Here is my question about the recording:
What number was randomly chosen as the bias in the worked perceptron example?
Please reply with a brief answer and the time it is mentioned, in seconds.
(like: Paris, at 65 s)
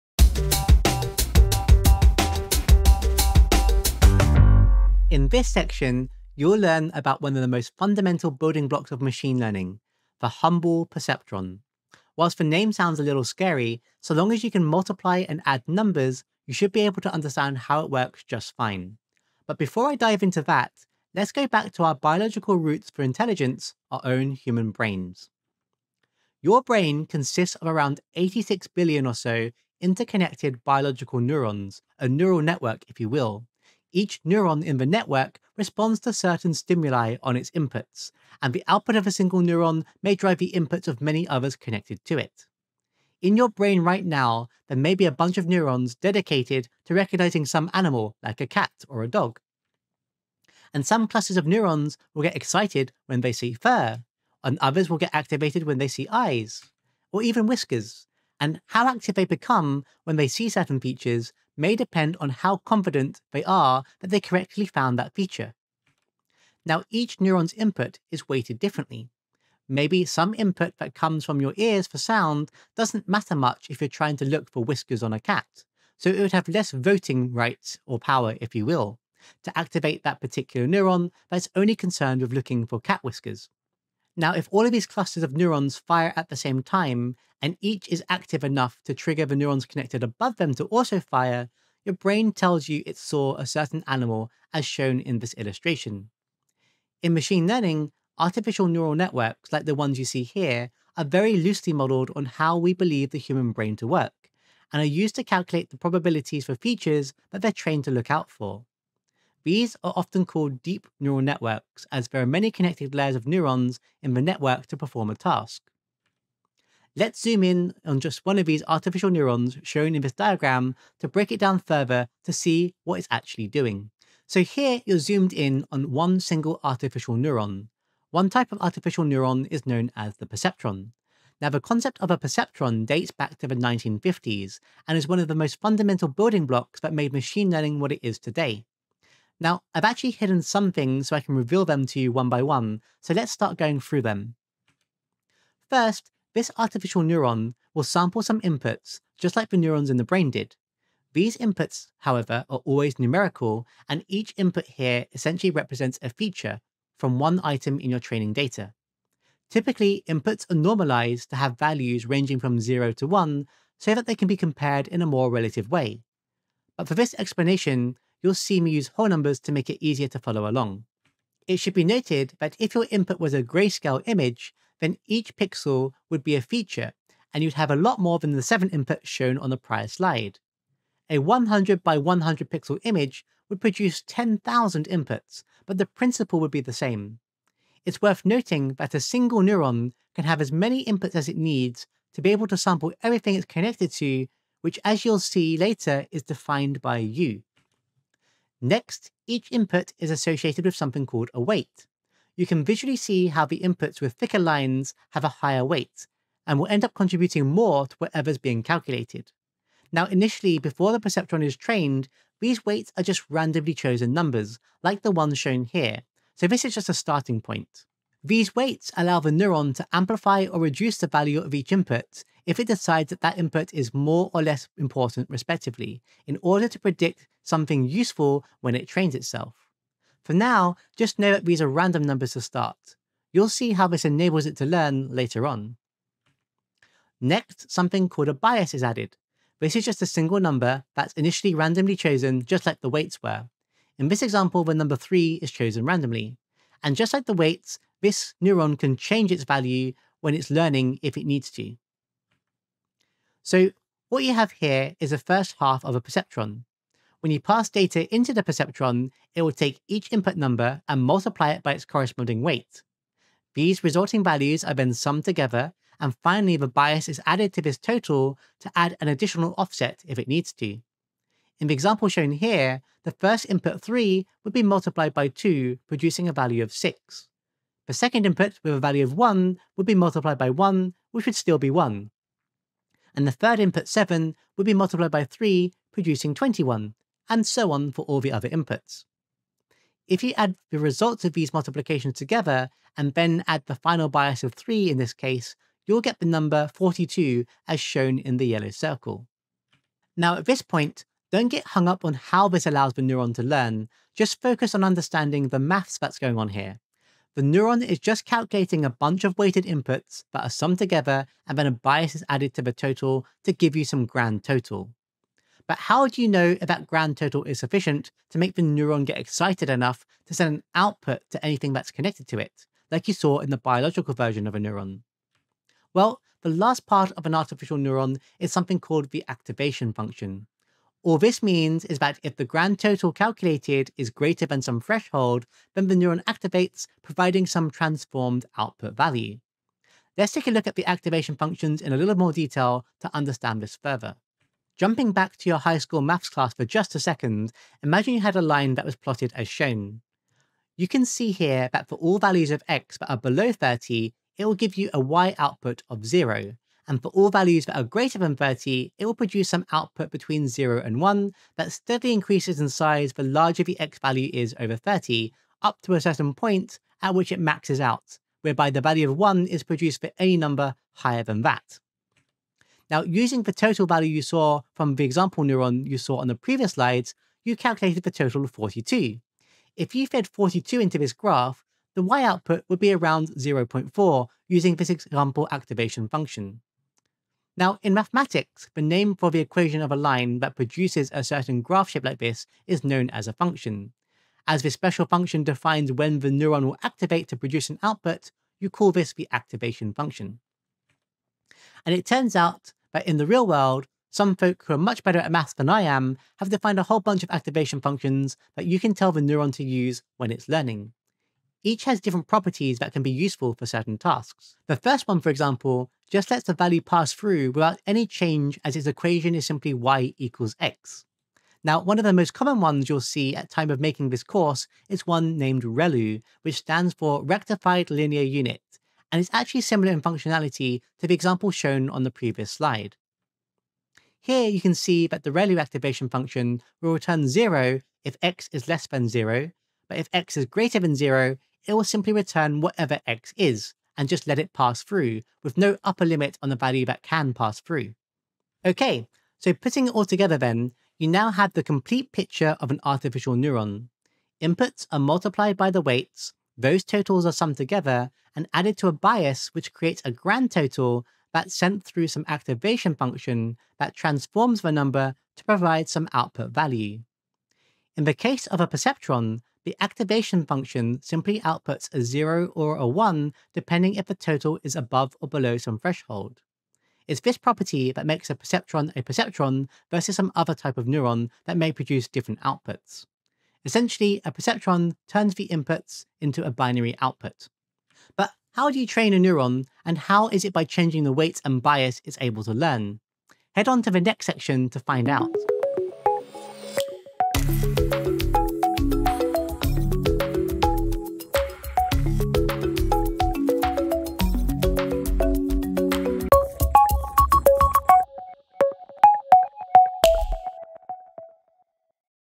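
3, at 244 s.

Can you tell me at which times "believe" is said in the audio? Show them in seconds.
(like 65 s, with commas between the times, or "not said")
102 s.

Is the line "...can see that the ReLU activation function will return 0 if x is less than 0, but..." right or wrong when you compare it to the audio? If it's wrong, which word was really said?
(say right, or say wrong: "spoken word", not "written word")
right.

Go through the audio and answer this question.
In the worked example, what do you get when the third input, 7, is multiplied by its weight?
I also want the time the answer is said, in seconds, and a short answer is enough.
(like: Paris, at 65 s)
21, at 286 s.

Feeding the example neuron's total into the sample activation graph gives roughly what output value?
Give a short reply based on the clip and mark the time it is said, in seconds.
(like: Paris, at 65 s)
0.4, at 383 s.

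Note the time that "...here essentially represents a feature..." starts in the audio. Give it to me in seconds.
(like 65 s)
154 s.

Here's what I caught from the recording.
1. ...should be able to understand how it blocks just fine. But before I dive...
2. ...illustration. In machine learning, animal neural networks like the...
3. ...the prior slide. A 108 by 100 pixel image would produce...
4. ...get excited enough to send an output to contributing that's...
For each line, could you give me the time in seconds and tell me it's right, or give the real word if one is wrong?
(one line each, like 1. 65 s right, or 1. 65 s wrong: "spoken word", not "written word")
1. 16 s wrong: "works", not "blocks"
2. 95 s wrong: "artificial", not "animal"
3. 179 s wrong: "100", not "108"
4. 319 s wrong: "anything", not "contributing".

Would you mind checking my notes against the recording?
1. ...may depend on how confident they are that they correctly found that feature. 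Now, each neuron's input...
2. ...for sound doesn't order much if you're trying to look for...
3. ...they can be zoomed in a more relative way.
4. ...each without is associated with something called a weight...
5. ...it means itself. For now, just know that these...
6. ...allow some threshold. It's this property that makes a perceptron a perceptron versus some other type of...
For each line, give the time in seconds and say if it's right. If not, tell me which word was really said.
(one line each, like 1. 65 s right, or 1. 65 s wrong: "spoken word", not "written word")
1. 61 s right
2. 71 s wrong: "matter", not "order"
3. 164 s wrong: "compared", not "zoomed"
4. 199 s wrong: "input", not "without"
5. 228 s wrong: "trains", not "means"
6. 475 s wrong: "below", not "allow".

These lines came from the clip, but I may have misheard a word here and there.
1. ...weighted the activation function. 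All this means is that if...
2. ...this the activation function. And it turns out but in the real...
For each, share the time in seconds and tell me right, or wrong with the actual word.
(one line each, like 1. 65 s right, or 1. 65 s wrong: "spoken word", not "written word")
1. 328 s wrong: "called", not "weighted"
2. 398 s right.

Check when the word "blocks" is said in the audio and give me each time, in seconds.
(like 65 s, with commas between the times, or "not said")
8 s, 136 s.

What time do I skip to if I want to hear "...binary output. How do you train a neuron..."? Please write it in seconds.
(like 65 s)
486 s.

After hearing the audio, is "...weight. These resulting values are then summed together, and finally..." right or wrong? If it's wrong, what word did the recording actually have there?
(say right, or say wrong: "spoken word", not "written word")
right.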